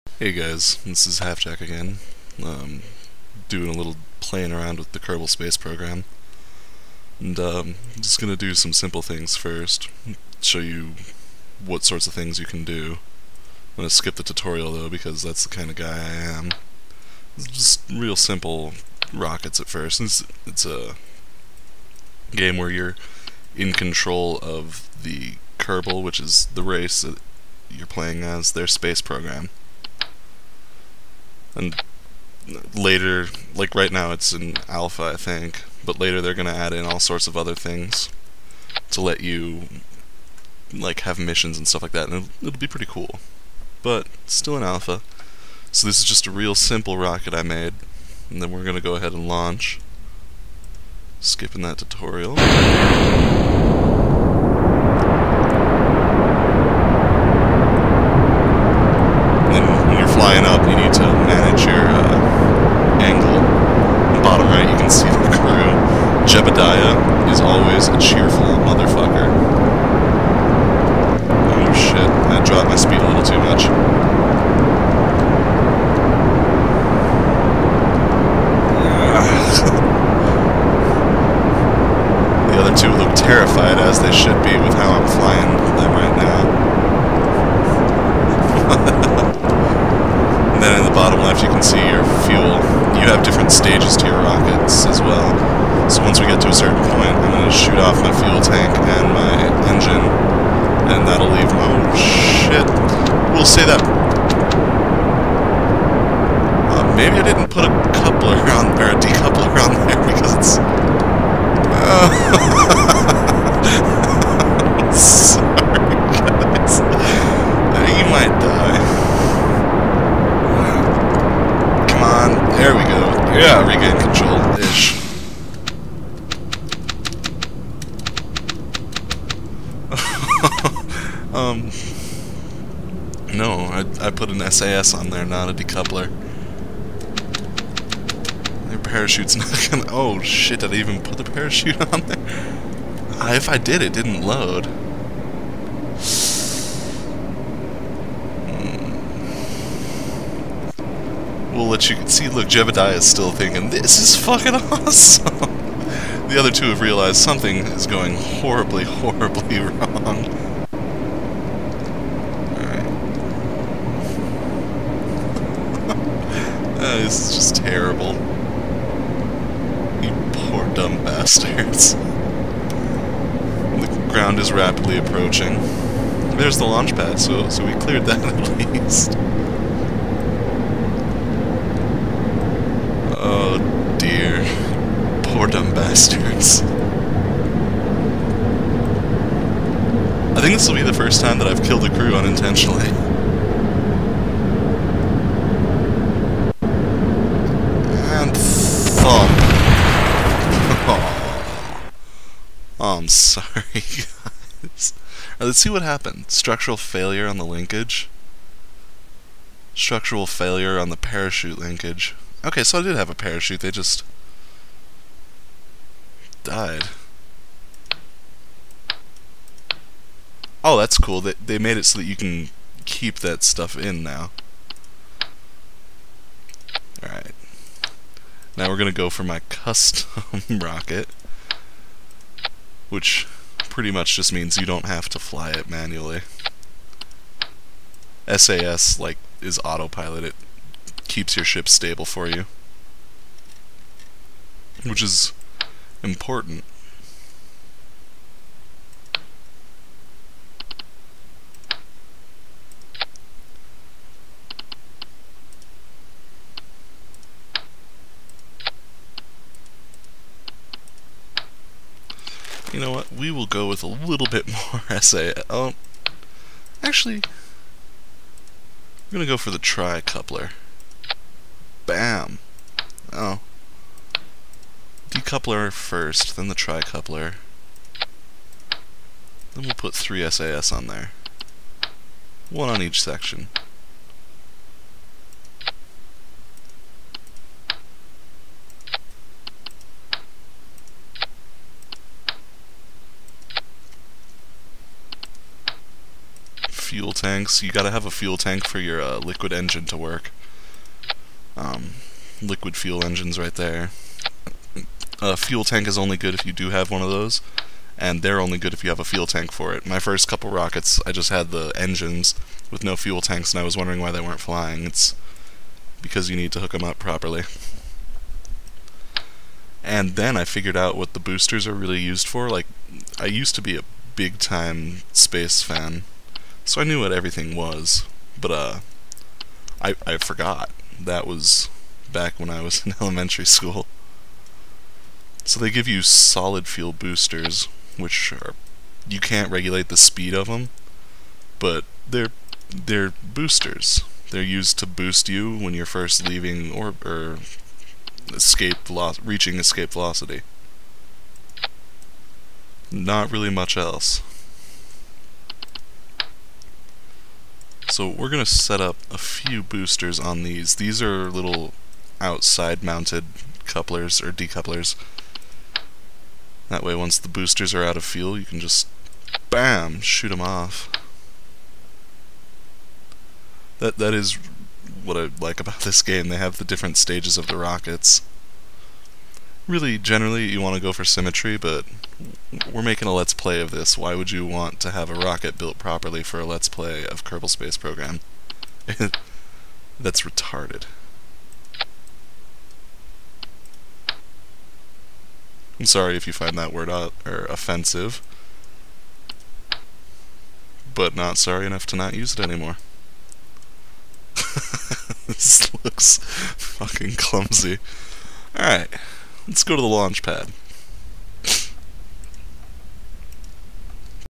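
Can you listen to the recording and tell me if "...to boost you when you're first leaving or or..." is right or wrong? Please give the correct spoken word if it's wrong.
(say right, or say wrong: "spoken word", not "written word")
right.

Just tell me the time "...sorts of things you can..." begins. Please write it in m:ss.
0:11.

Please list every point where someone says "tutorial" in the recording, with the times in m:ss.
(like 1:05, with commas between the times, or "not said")
0:14, 0:51.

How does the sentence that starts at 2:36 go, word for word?
the other two have realized something is going horribly, horribly wrong.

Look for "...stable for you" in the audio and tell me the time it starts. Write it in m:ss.
4:01.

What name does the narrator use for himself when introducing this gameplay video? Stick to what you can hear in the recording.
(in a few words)
Halfjack.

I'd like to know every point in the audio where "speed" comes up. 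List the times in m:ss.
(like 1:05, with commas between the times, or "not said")
1:12, 5:39.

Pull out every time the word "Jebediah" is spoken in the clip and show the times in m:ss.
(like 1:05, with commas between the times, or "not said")
1:06, 2:32.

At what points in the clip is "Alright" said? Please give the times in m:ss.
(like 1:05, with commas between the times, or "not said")
3:47, 6:48.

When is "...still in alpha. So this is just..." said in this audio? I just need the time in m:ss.
0:44.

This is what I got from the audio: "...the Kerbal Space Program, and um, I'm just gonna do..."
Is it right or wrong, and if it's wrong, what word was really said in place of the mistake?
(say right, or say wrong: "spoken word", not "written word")
right.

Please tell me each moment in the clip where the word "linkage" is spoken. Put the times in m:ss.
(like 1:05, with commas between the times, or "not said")
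3:27, 3:31.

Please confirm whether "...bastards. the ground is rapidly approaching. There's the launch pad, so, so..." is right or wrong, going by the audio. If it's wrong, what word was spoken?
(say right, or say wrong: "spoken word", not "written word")
right.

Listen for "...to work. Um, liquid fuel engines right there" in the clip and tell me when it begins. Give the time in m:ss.
4:59.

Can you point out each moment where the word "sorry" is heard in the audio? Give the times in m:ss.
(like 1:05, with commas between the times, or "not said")
3:23, 6:35, 6:41.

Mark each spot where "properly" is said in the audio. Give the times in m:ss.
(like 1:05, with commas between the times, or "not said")
5:16, 6:25.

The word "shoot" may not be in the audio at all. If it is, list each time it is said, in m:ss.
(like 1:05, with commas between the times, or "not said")
1:37, 6:09.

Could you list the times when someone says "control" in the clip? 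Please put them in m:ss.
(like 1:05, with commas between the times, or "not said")
0:23.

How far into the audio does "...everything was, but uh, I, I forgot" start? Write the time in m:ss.
5:27.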